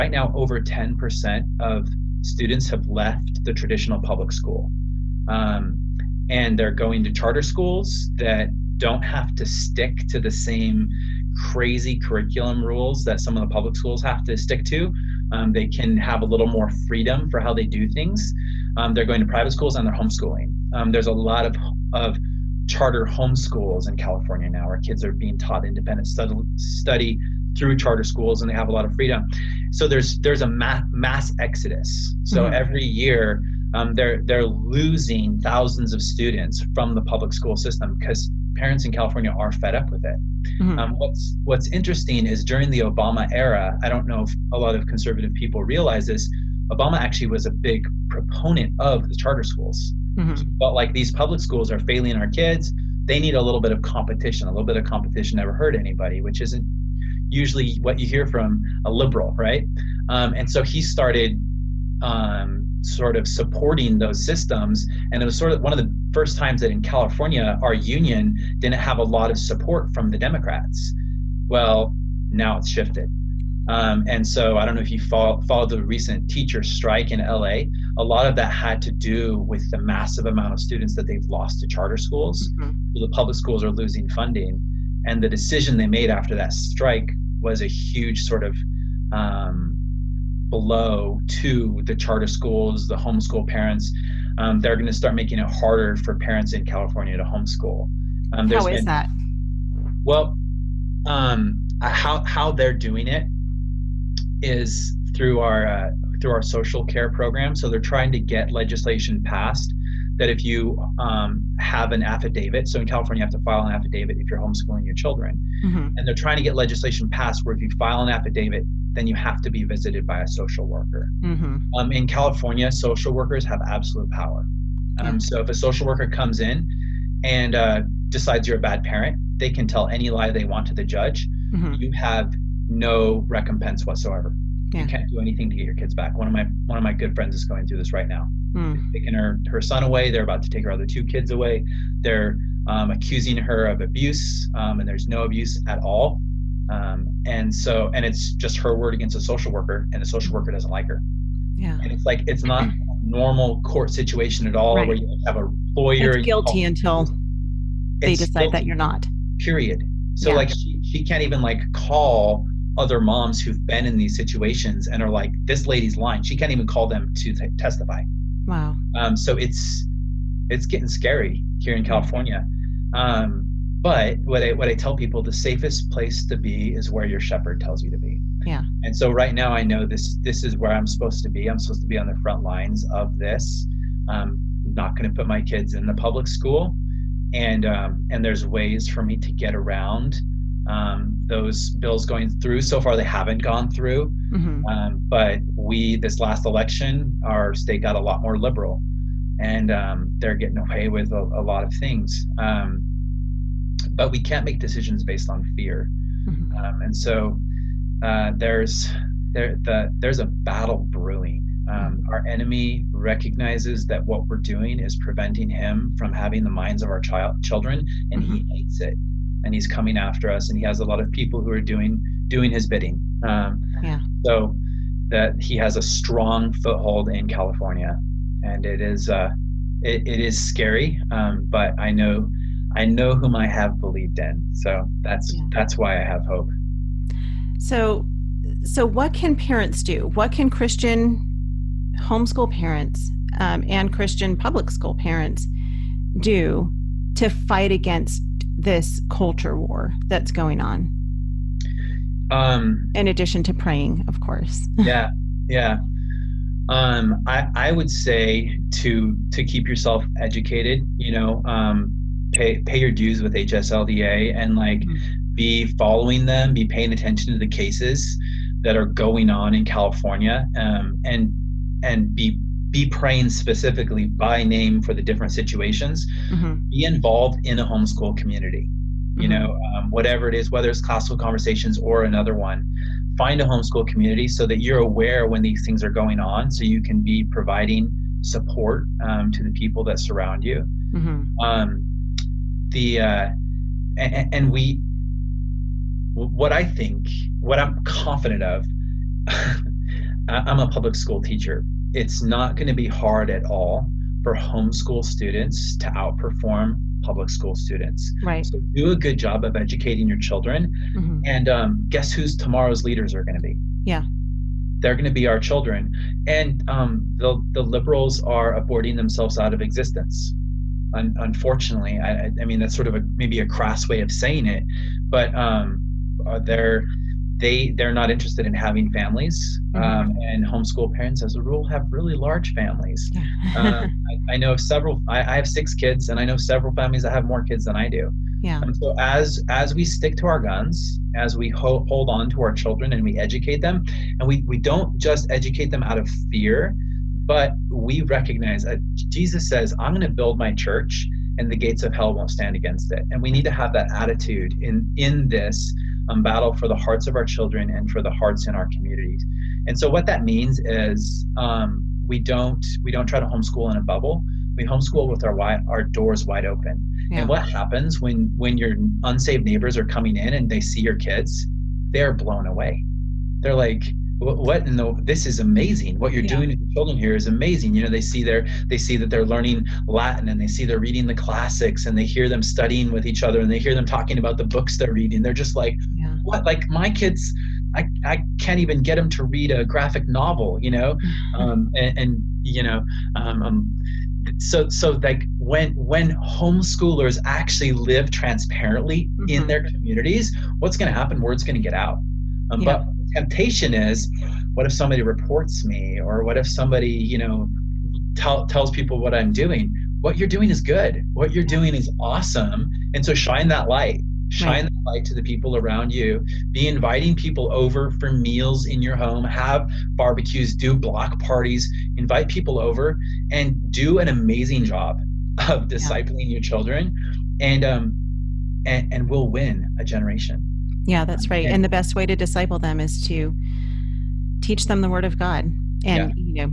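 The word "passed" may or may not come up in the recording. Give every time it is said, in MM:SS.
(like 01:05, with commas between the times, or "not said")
01:49, 01:57.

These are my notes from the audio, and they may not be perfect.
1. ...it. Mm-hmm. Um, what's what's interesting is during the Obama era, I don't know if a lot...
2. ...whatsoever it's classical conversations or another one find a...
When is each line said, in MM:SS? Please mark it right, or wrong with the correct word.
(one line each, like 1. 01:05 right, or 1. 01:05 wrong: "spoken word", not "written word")
1. 00:40 right
2. 04:40 wrong: "whether", not "whatsoever".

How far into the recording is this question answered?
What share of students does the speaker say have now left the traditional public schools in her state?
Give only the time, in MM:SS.
00:00.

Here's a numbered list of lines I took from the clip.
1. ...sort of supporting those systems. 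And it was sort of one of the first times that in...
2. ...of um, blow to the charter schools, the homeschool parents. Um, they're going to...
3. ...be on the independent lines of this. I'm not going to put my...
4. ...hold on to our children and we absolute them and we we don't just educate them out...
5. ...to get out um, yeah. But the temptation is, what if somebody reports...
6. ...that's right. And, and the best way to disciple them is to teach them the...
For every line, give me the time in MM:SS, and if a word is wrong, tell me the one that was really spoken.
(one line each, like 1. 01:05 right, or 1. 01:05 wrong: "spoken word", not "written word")
1. 01:02 right
2. 01:28 right
3. 03:01 wrong: "front", not "independent"
4. 05:41 wrong: "educate", not "absolute"
5. 06:41 right
6. 07:11 right.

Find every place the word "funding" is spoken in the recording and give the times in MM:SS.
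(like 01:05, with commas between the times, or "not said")
01:24.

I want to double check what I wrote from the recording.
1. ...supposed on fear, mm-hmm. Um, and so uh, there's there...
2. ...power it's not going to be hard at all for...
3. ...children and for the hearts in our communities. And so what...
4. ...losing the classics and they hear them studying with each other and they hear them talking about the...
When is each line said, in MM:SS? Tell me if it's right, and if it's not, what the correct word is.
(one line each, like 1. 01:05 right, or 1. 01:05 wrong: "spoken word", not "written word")
1. 03:25 wrong: "based", not "supposed"
2. 05:01 wrong: "teacher", not "power"
3. 05:57 right
4. 06:20 wrong: "reading", not "losing".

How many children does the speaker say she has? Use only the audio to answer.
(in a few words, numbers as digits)
6.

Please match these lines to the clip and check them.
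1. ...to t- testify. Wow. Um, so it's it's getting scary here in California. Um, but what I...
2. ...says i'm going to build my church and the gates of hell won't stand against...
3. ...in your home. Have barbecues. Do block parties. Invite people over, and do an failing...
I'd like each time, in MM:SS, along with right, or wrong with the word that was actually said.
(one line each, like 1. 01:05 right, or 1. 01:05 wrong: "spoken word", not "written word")
1. 02:47 right
2. 05:49 right
3. 06:58 wrong: "amazing", not "failing".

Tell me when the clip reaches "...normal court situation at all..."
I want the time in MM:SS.
02:33.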